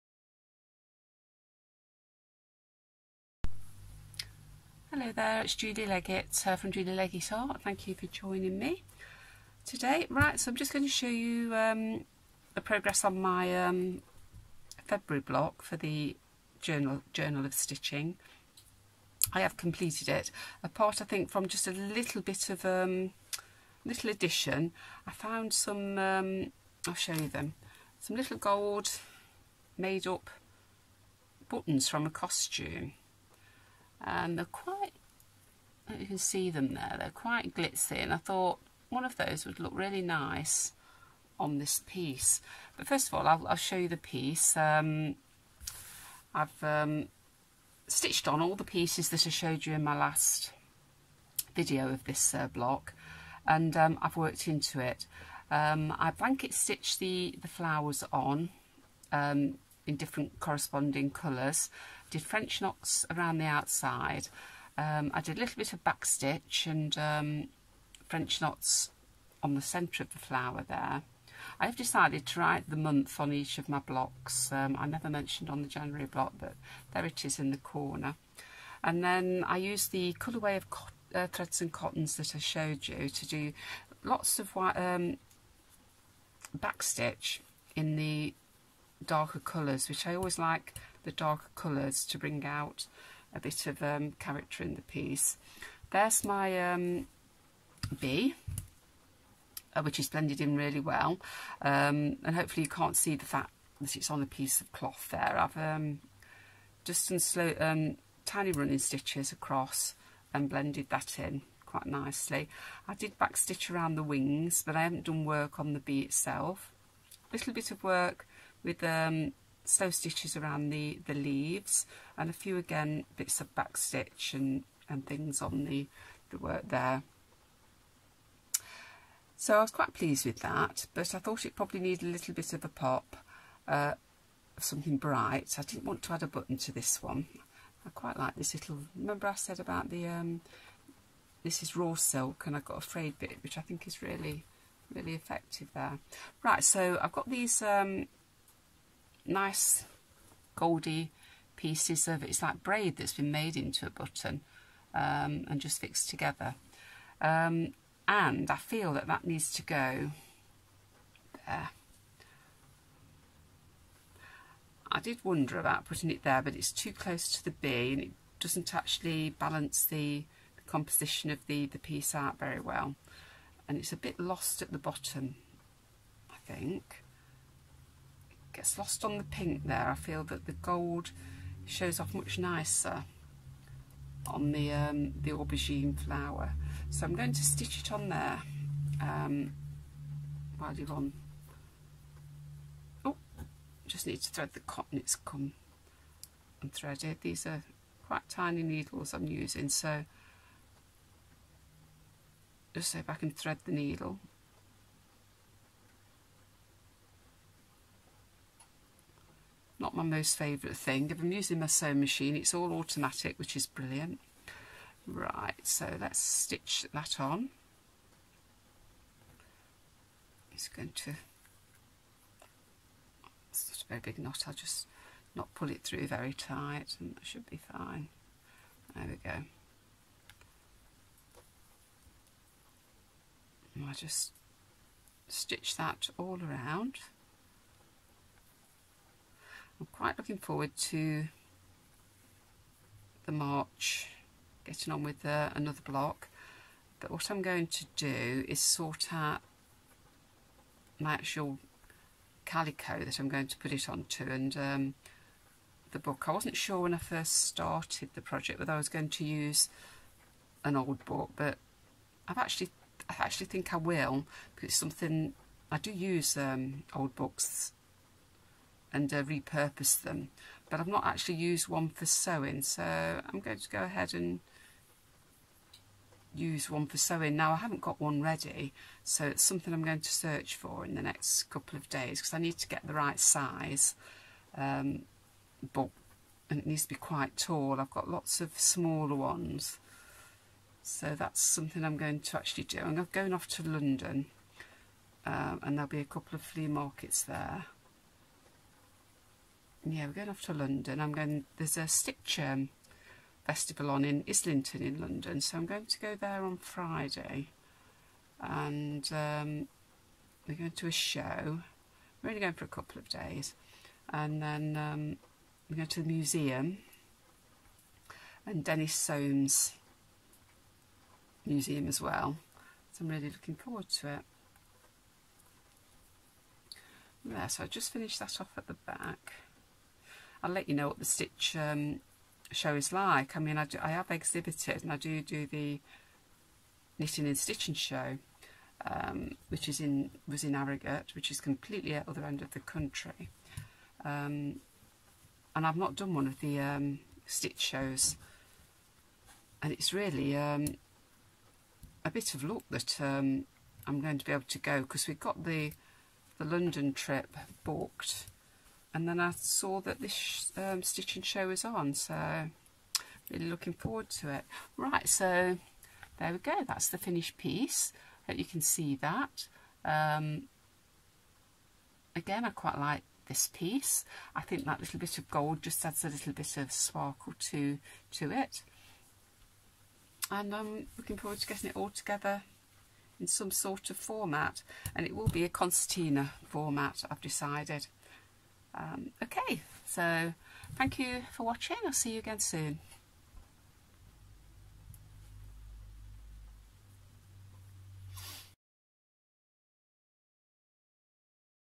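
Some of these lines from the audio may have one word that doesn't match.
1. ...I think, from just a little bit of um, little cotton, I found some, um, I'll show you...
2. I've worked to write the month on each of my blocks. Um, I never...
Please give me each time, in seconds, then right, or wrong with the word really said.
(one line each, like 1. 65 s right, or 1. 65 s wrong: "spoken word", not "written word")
1. 21 s wrong: "addition", not "cotton"
2. 71 s wrong: "decided", not "worked".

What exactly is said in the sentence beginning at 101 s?
Um, and hopefully you can't see the fact that it's on a piece of cloth there.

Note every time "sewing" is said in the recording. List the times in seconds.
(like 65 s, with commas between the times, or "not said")
211 s, 272 s, 276 s.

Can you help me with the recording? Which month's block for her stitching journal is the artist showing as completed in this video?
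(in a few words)
February.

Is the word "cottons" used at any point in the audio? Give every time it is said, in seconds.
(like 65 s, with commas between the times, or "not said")
81 s, 194 s.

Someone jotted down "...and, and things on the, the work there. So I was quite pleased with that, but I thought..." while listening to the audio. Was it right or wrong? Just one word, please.
right.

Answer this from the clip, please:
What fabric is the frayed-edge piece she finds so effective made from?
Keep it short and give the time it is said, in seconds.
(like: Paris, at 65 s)
Raw silk, at 141 s.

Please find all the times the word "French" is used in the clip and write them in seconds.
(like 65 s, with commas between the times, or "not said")
62 s, 68 s.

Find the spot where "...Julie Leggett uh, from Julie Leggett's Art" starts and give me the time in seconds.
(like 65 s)
5 s.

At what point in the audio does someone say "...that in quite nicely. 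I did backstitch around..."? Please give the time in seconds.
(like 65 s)
110 s.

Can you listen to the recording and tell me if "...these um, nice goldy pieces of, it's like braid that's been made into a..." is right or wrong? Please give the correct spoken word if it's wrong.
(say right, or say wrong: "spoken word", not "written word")
right.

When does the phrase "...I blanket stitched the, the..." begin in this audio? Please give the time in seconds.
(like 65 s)
55 s.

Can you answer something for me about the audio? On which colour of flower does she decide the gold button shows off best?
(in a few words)
Aubergine.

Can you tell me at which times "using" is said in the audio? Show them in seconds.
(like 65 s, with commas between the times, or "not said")
199 s, 211 s.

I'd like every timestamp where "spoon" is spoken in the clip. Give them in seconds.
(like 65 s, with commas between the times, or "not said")
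not said.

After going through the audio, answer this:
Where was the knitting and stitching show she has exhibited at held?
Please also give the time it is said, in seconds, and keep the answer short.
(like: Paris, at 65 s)
Harrogate, at 340 s.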